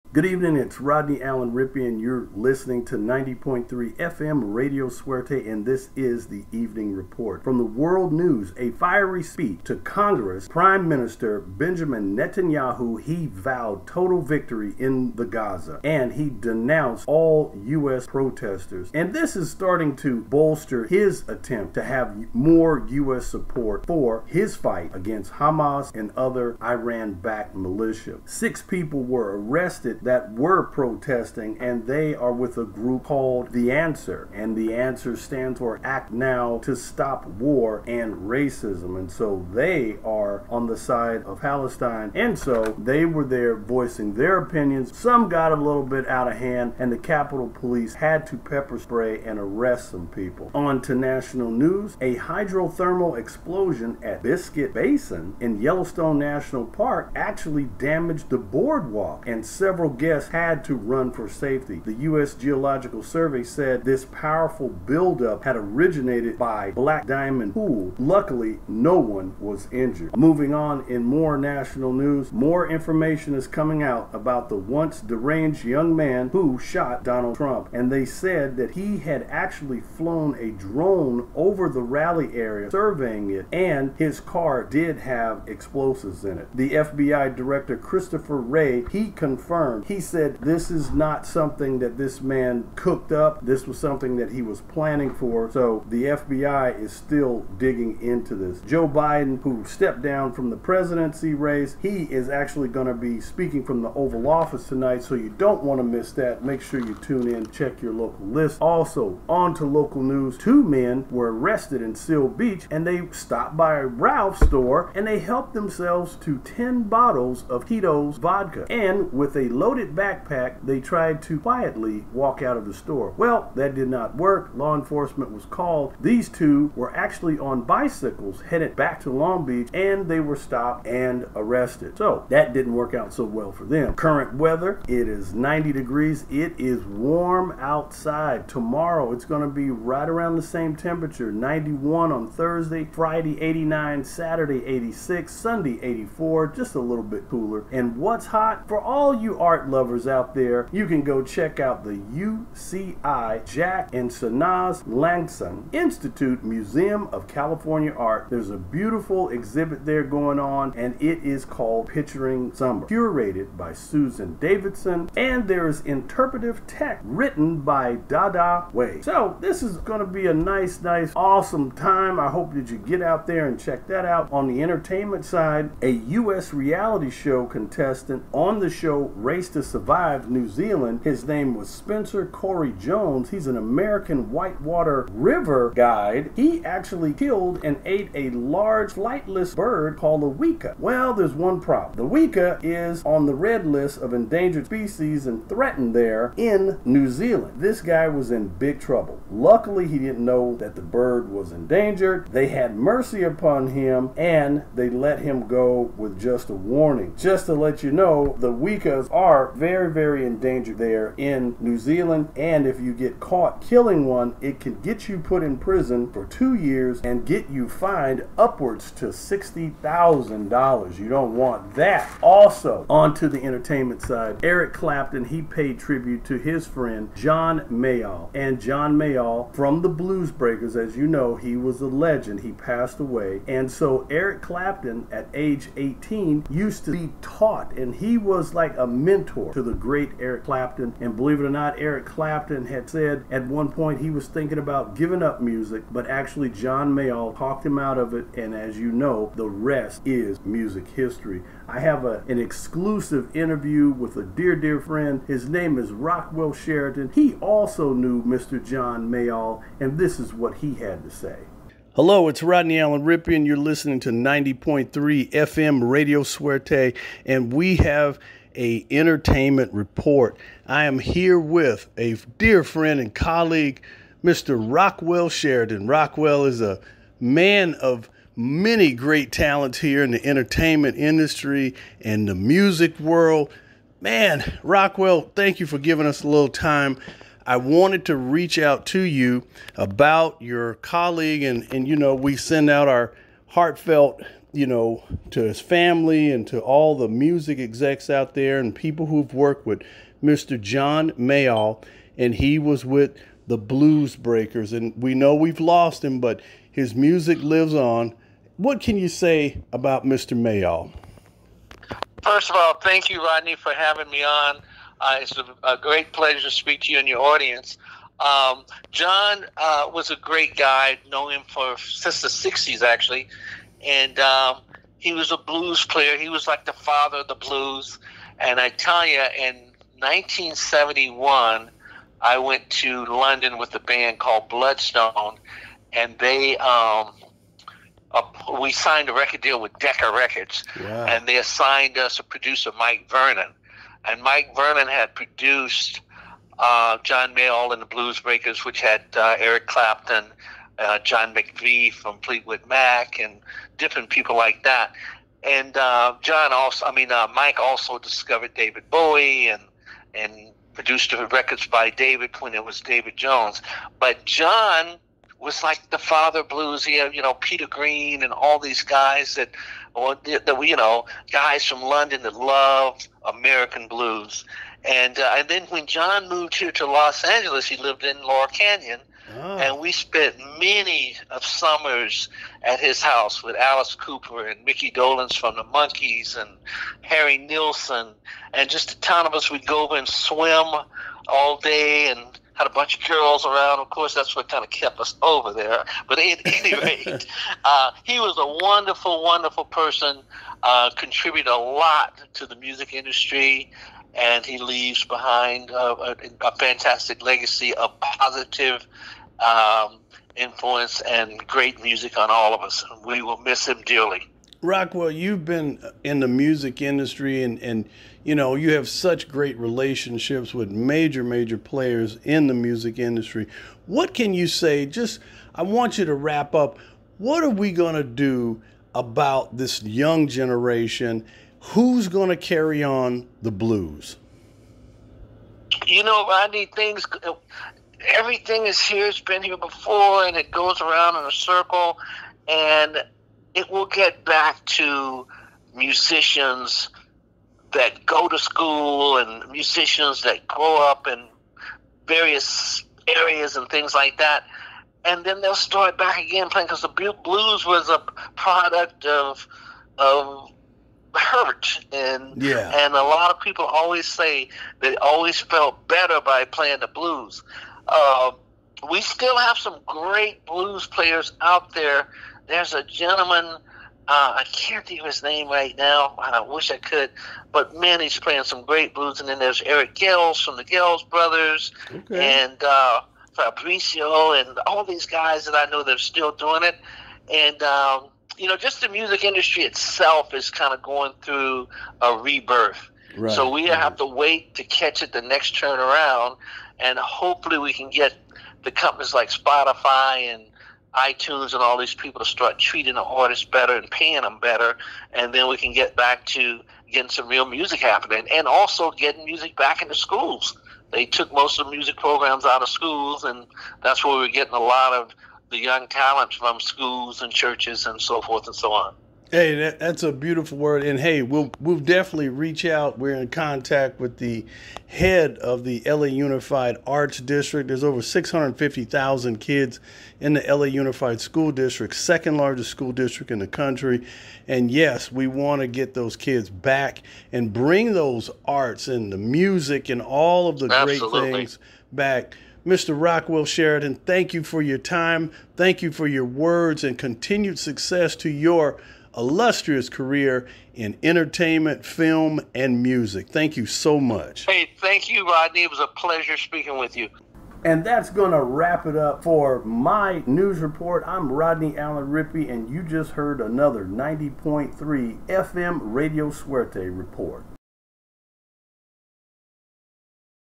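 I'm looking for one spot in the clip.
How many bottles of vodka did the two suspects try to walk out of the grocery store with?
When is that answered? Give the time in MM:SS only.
01:56.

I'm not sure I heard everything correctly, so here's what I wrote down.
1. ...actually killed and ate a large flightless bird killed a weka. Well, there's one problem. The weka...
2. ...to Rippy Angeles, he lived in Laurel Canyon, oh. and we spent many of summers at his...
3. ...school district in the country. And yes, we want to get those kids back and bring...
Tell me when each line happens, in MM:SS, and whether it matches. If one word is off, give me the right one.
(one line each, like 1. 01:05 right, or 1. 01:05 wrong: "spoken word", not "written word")
1. 03:06 wrong: "called", not "killed"
2. 06:16 wrong: "Los", not "Rippy"
3. 08:52 right.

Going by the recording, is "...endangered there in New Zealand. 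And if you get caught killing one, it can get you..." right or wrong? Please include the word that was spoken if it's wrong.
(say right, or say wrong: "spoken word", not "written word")
right.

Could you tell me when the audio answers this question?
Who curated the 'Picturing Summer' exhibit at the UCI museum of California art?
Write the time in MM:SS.
02:43.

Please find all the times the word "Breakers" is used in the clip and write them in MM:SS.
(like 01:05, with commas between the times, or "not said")
03:50, 05:04, 05:48.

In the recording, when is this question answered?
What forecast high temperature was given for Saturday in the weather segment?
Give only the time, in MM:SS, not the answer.
02:24.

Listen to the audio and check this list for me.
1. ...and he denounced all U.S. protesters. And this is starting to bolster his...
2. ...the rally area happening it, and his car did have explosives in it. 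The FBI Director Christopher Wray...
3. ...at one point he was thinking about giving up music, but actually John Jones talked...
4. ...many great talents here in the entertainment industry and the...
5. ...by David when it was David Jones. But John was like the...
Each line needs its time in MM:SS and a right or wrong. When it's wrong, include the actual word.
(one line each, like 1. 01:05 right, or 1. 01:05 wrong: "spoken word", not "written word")
1. 00:15 right
2. 01:21 wrong: "surveying", not "happening"
3. 04:03 wrong: "Mayall", not "Jones"
4. 04:38 right
5. 06:01 right.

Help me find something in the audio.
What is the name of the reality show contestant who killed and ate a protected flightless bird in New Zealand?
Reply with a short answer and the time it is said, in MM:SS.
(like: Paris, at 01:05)
Spencer Corey Jones, at 03:01.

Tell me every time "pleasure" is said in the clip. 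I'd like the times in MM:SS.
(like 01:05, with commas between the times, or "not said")
05:16, 09:15.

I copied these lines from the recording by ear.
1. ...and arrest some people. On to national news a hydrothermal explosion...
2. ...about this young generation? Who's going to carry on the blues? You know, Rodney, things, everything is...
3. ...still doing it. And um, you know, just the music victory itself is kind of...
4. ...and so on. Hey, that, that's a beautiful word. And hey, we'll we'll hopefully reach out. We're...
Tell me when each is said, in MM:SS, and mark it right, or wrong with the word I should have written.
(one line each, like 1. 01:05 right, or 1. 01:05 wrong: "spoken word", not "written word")
1. 00:49 right
2. 07:08 right
3. 08:05 wrong: "industry", not "victory"
4. 08:38 wrong: "definitely", not "hopefully".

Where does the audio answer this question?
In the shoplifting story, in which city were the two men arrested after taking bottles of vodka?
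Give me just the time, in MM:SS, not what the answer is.
01:51.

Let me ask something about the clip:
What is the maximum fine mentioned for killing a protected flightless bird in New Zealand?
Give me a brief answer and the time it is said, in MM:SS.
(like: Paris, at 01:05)
$60,000, at 03:39.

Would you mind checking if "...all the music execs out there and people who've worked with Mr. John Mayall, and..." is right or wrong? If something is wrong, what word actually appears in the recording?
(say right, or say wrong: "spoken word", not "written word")
right.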